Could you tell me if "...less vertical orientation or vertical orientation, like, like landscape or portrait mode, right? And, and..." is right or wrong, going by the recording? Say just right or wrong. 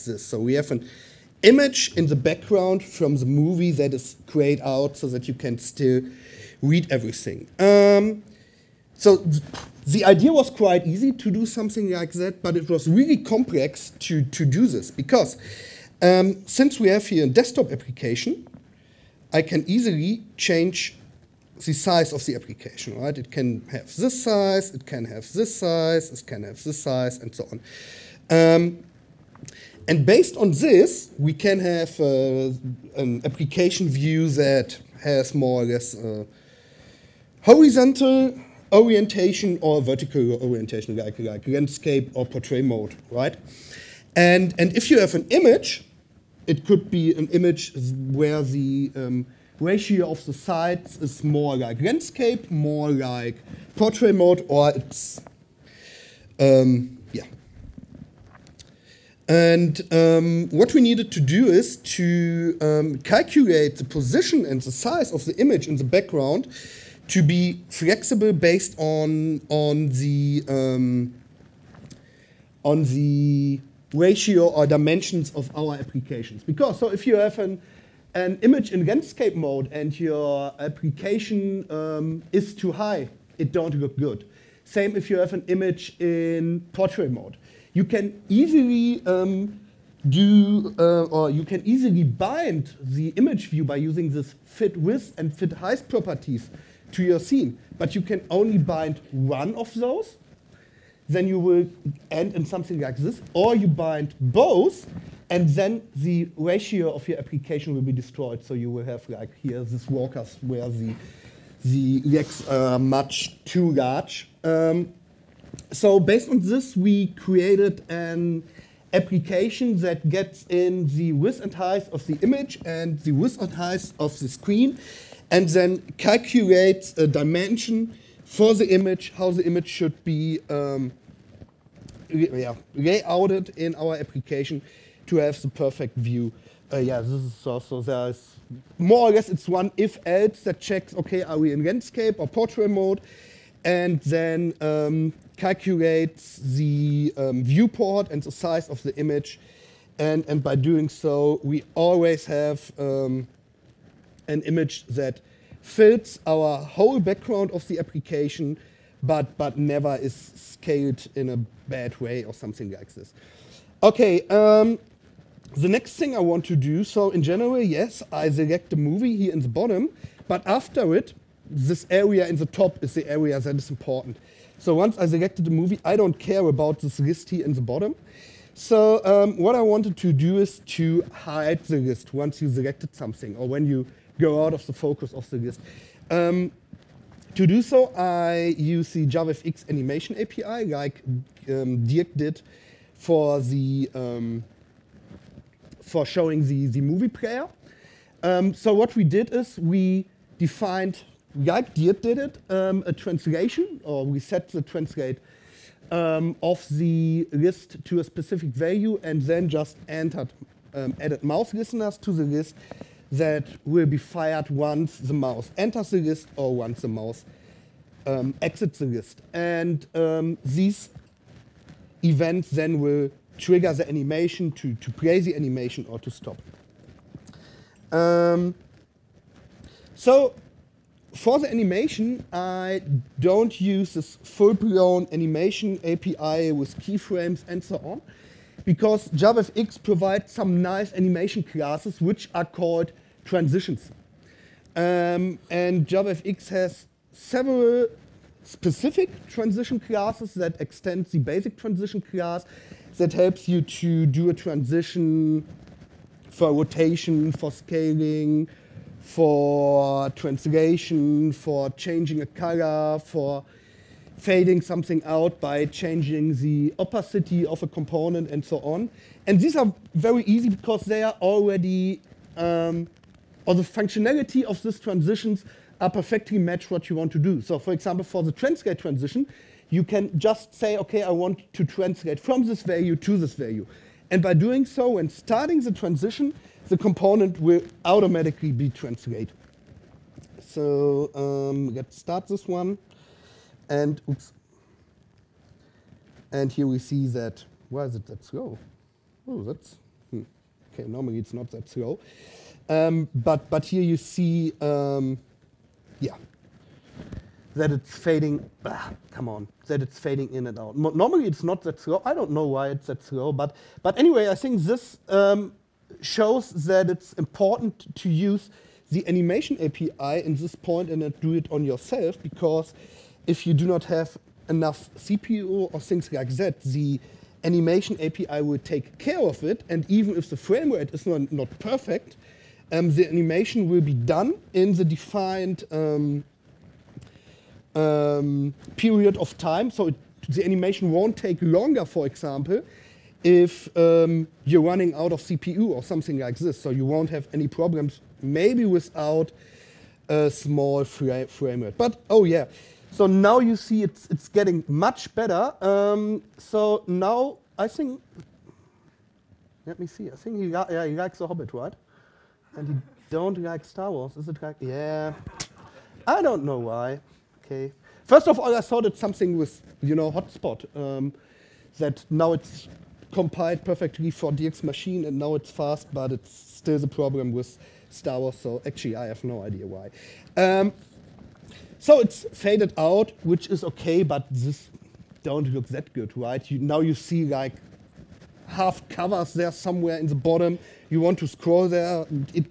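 wrong.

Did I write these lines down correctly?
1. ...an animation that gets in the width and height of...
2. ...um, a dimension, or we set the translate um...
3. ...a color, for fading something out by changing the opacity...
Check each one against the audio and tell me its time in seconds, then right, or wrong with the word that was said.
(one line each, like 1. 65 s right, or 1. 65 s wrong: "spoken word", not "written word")
1. 117 s wrong: "application", not "animation"
2. 202 s wrong: "translation", not "dimension"
3. 262 s right.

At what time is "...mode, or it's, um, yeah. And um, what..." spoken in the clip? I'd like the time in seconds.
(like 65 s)
54 s.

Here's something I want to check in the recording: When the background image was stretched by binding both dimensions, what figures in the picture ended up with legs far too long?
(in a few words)
walkers.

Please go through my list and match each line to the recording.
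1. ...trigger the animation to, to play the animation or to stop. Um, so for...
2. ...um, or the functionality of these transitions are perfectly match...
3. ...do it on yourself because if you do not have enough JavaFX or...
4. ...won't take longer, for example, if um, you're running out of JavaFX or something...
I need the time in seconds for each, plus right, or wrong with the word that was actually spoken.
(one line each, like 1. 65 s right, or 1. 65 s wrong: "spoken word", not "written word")
1. 223 s right
2. 272 s right
3. 321 s wrong: "CPU", not "JavaFX"
4. 340 s wrong: "CPU", not "JavaFX".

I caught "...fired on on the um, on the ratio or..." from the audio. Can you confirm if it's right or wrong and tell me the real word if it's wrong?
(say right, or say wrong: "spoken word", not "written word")
wrong: "based", not "fired".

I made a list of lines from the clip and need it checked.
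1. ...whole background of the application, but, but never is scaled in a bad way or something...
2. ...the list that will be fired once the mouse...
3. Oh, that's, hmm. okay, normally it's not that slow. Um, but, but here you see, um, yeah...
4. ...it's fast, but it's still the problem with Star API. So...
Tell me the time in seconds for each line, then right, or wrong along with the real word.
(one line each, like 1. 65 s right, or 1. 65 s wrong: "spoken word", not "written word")
1. 156 s right
2. 212 s right
3. 299 s right
4. 375 s wrong: "Wars", not "API".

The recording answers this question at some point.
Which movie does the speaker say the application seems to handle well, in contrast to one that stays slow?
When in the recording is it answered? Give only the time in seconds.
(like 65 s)
361 s.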